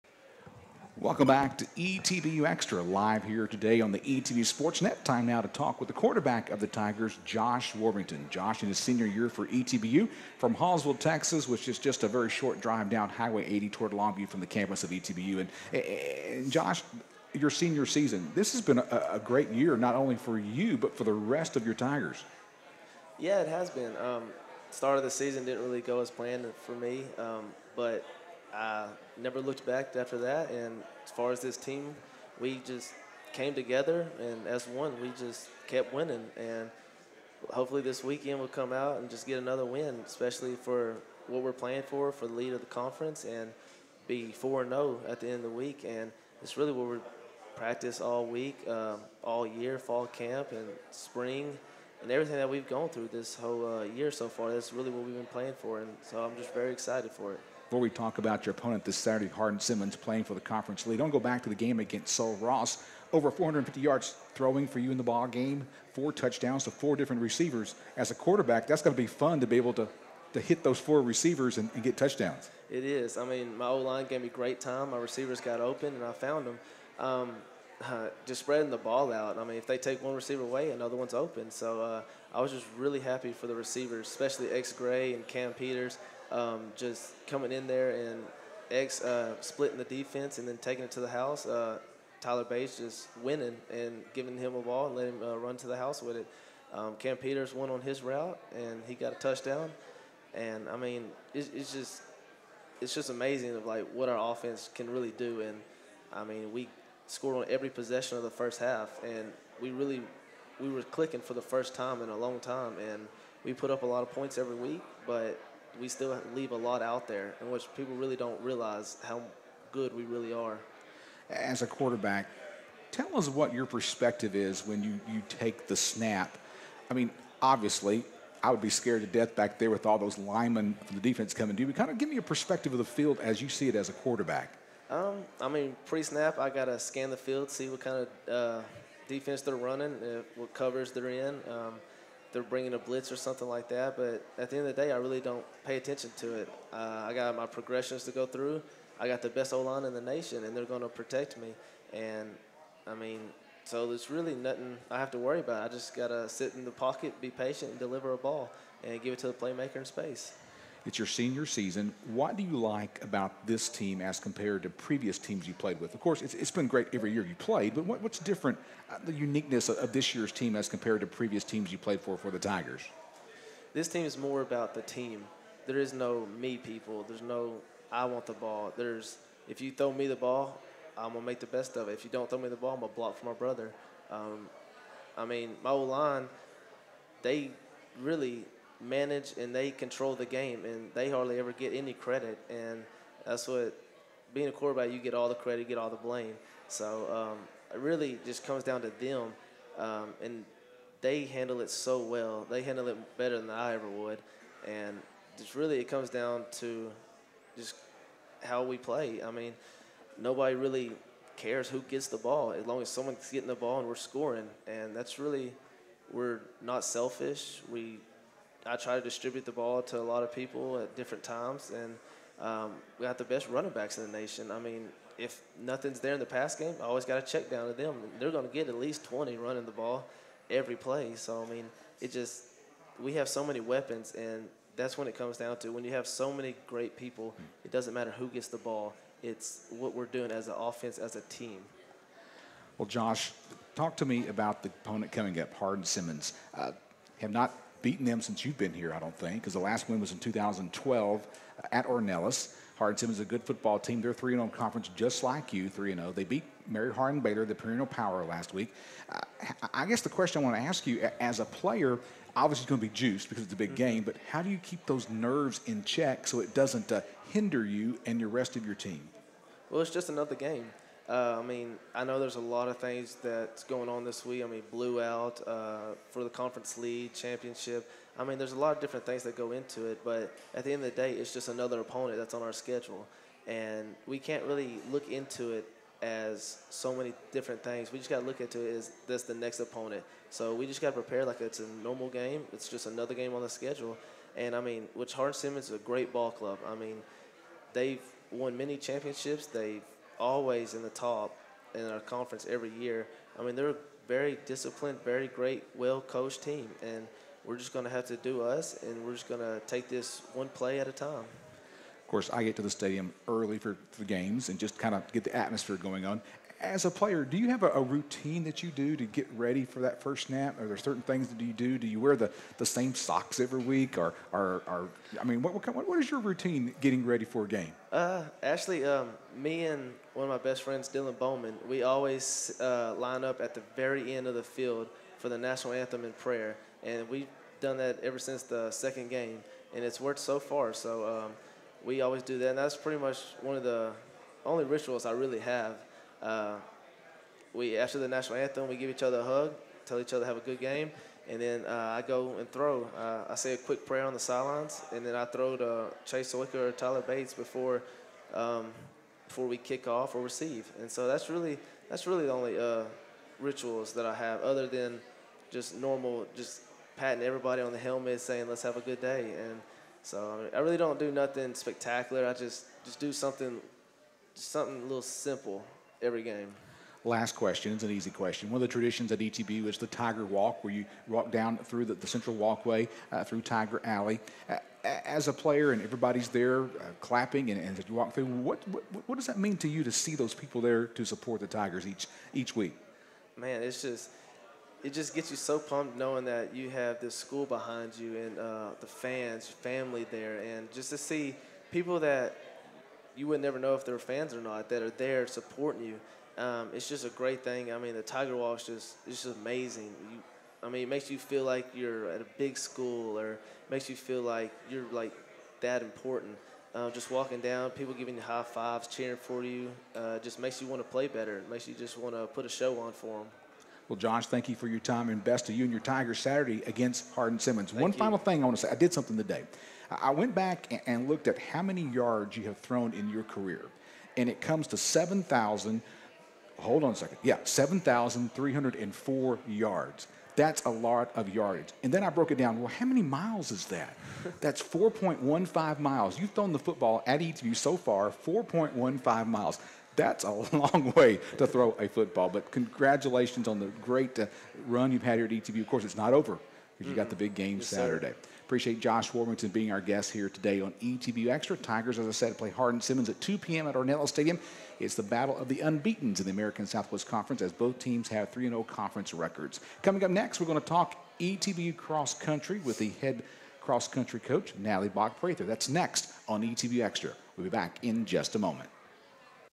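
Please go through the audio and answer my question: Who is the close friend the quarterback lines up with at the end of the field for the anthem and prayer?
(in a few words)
Dylan Bowman.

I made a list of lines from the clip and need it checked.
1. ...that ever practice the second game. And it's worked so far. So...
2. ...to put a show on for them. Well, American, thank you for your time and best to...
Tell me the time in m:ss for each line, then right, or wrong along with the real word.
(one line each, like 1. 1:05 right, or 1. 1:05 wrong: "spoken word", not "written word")
1. 5:37 wrong: "since", not "practice"
2. 7:02 wrong: "Josh", not "American".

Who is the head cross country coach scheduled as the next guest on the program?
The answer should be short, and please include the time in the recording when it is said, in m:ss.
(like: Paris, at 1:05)
Natalie Bach Prather, at 7:54.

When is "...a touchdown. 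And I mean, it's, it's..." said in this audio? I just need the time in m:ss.
1:39.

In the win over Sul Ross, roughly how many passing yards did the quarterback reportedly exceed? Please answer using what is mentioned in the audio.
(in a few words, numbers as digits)
450.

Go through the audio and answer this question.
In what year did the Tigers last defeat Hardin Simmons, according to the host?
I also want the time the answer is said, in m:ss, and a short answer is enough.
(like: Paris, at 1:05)
2012, at 4:10.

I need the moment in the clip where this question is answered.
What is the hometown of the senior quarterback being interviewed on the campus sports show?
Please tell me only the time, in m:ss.
0:10.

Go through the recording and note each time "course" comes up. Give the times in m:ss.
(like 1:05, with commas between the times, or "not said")
2:45, 5:12, 7:35.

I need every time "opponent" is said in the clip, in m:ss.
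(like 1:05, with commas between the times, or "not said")
0:58, 4:04, 4:41, 4:49.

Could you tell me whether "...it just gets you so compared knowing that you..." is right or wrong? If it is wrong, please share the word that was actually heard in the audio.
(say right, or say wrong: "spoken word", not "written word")
wrong: "pumped", not "compared".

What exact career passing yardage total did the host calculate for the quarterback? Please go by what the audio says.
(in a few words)
7,304 yards.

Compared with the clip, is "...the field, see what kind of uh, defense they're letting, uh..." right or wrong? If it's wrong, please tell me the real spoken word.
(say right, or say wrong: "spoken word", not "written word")
wrong: "running", not "letting".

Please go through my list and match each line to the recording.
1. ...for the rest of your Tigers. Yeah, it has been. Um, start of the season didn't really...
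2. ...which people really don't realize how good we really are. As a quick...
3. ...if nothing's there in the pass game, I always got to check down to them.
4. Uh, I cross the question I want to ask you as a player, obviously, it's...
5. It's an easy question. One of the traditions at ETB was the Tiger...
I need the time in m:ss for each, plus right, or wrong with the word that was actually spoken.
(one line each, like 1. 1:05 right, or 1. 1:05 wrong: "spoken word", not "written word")
1. 0:20 right
2. 1:57 wrong: "quarterback", not "quick"
3. 3:45 right
4. 4:19 wrong: "guess", not "cross"
5. 6:17 right.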